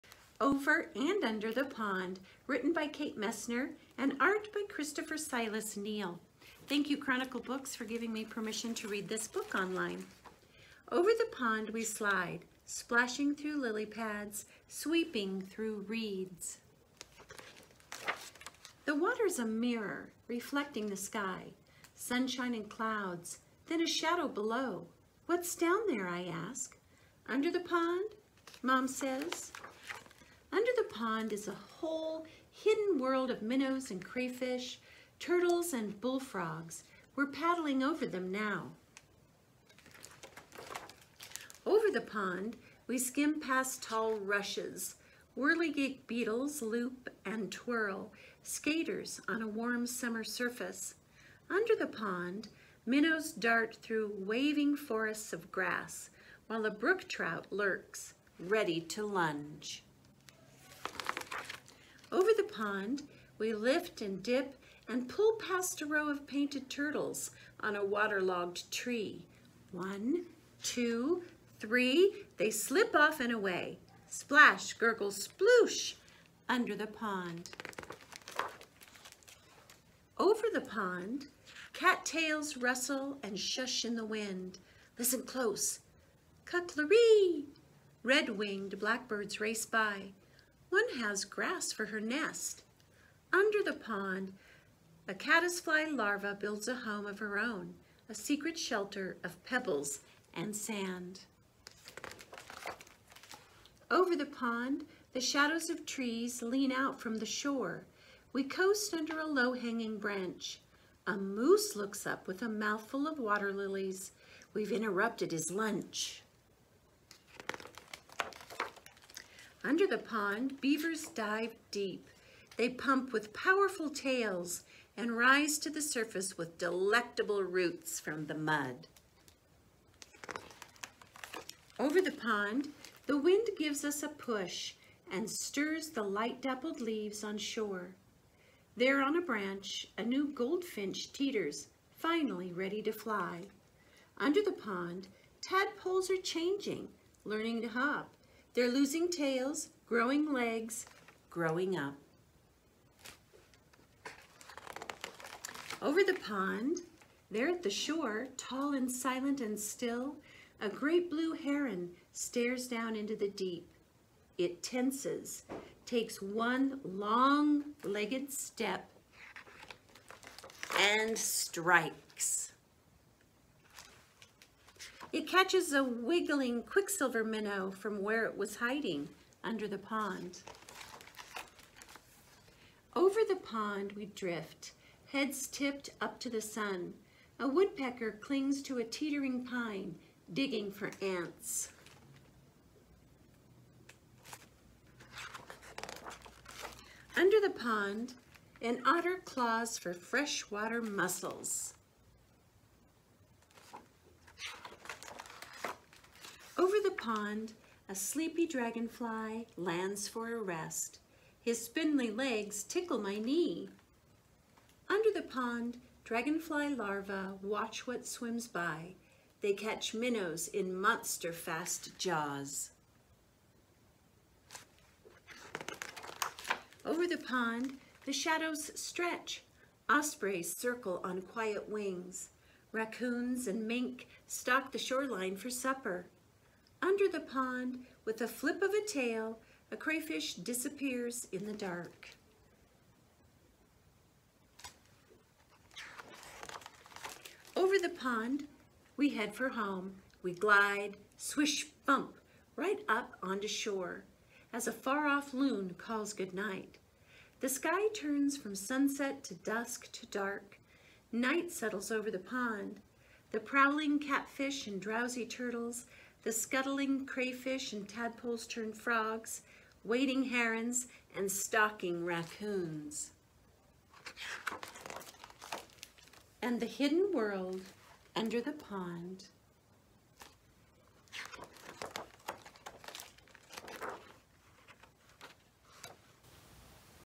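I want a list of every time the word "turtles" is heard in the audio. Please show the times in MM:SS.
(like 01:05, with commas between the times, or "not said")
00:35, 01:06, 04:25.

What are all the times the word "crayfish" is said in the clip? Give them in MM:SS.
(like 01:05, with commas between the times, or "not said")
00:34, 03:59, 04:27.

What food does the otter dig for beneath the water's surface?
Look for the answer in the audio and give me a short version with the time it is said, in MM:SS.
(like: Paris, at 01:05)
freshwater mussels, at 03:19.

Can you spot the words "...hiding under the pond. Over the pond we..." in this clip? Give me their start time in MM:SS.
02:58.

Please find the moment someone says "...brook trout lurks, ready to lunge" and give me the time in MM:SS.
00:56.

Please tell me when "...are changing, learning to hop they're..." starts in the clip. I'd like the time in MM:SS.
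02:26.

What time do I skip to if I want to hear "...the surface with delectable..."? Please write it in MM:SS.
02:05.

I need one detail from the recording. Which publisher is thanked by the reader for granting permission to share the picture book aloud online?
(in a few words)
Chronicle Books.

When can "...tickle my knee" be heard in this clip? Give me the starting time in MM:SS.
03:32.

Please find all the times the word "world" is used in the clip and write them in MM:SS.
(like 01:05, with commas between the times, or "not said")
00:32, 04:37.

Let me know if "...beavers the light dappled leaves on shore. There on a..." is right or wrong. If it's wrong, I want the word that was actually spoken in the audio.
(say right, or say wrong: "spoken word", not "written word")
wrong: "stirs", not "beavers".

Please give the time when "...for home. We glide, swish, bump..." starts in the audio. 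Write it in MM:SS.
04:09.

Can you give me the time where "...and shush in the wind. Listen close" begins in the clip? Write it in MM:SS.
01:23.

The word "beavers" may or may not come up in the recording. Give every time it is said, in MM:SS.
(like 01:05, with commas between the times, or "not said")
02:00.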